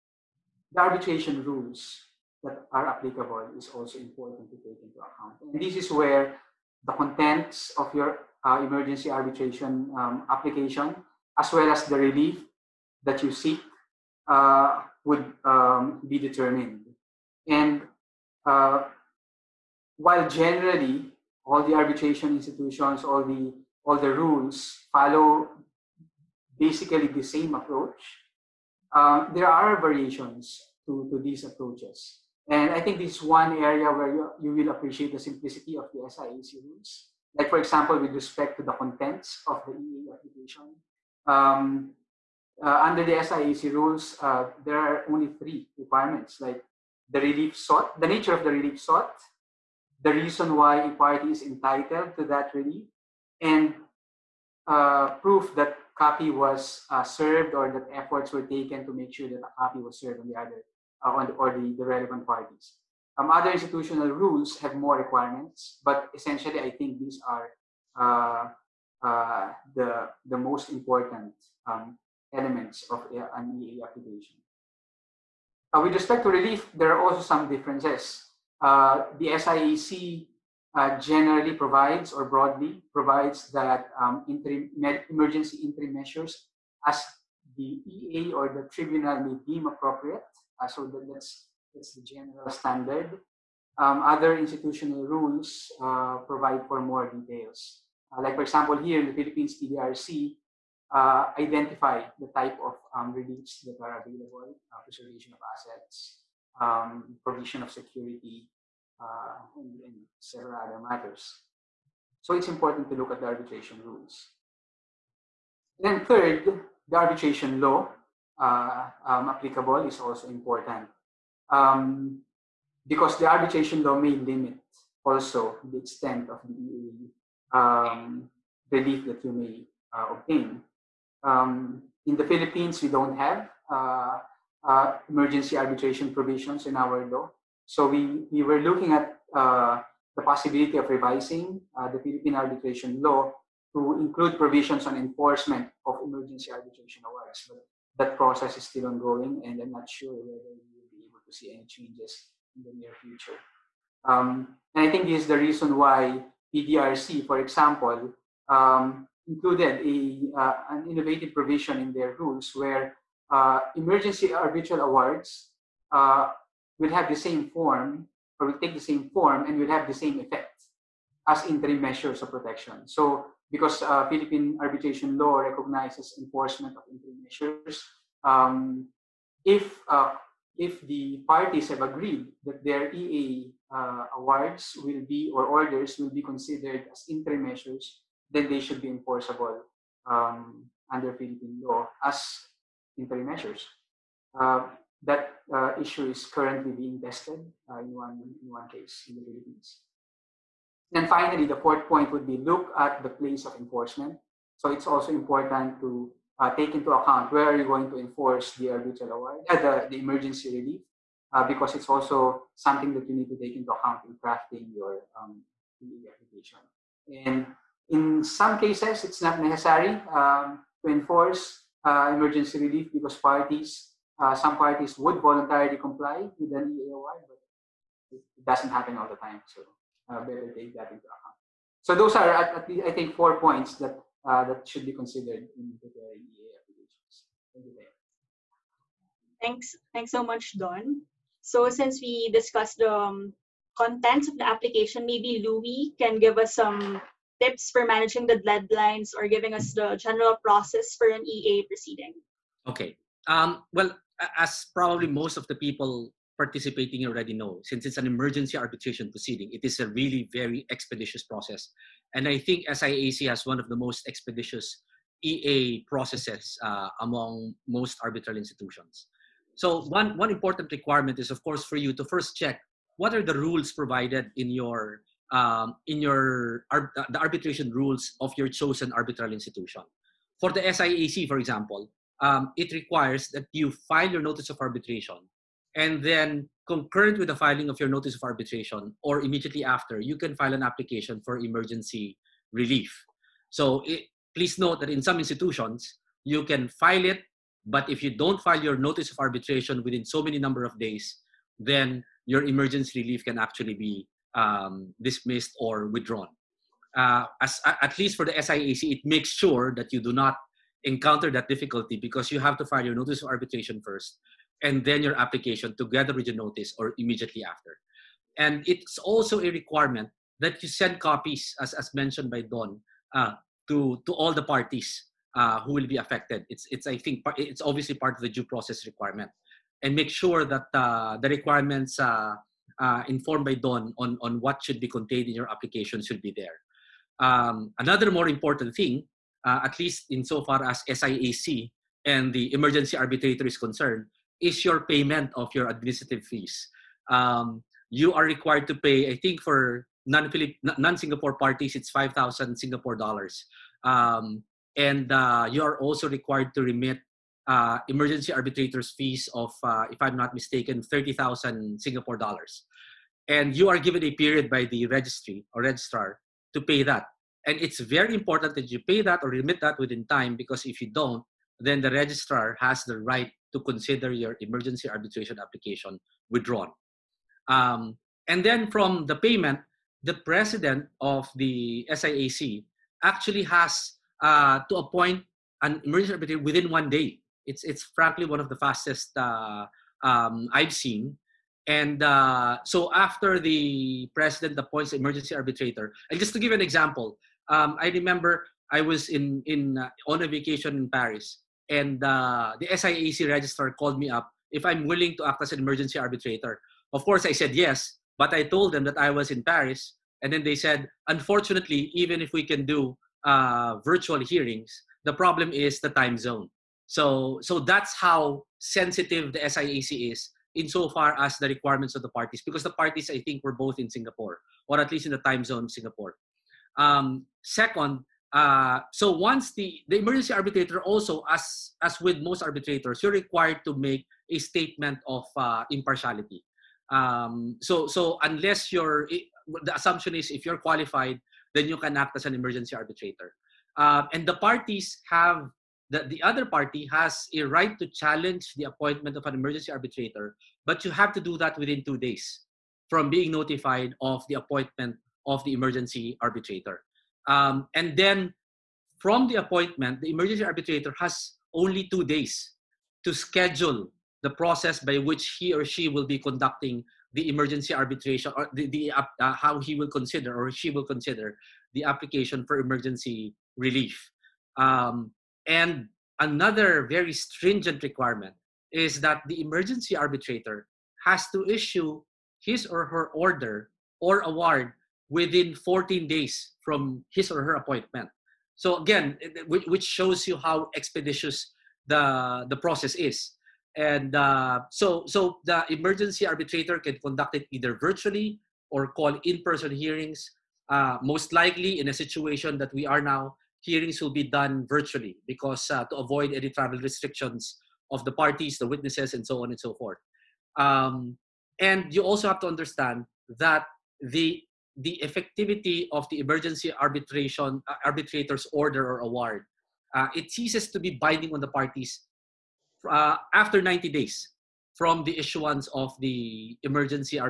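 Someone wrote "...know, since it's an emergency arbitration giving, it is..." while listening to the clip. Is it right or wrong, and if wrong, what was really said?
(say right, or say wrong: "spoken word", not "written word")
wrong: "proceeding", not "giving".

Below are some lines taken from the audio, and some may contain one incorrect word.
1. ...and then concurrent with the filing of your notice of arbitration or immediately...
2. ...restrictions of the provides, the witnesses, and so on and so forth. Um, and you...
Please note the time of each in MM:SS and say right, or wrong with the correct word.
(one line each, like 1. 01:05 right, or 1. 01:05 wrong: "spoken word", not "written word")
1. 04:45 right
2. 08:26 wrong: "parties", not "provides".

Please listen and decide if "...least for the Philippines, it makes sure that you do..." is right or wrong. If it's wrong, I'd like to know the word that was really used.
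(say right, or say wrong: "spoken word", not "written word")
wrong: "SIAC", not "Philippines".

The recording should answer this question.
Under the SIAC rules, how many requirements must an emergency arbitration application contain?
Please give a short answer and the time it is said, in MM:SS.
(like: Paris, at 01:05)
3, at 00:45.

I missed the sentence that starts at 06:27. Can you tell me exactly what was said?
It's it's frankly one of the fastest uh, um, I've seen.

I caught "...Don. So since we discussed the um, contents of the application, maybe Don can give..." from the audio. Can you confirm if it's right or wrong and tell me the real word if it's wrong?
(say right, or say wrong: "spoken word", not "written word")
wrong: "Louie", not "Don".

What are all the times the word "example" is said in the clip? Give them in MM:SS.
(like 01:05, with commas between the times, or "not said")
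00:37, 01:38, 02:37, 04:41, 06:36.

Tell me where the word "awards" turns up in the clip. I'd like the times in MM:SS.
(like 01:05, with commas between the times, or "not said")
02:27, 02:44, 03:04, 03:29, 08:04, 08:39.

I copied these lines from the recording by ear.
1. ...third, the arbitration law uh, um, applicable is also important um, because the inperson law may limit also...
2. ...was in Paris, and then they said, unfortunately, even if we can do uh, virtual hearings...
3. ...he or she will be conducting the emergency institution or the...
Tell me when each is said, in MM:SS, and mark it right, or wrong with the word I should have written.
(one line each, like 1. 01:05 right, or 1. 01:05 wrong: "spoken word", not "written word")
1. 01:56 wrong: "arbitration", not "inperson"
2. 06:49 right
3. 07:45 wrong: "arbitration", not "institution".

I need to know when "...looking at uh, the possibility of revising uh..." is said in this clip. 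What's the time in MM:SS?
02:18.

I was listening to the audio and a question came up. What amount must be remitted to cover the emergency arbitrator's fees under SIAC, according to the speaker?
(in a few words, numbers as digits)
30,000 Singapore dollars.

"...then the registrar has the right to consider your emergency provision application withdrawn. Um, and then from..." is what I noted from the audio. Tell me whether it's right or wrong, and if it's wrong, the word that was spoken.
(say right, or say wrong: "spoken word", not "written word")
wrong: "arbitration", not "provision".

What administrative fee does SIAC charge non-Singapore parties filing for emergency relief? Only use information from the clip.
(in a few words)
5,000 Singapore dollars.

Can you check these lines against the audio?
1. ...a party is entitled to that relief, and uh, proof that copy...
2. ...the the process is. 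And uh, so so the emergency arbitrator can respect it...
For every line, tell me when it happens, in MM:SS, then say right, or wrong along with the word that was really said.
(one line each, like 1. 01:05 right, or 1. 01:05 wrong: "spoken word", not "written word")
1. 00:50 right
2. 08:11 wrong: "conduct", not "respect".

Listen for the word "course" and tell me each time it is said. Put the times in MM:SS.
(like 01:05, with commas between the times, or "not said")
04:31, 06:47.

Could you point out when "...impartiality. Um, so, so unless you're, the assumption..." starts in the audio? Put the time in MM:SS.
07:15.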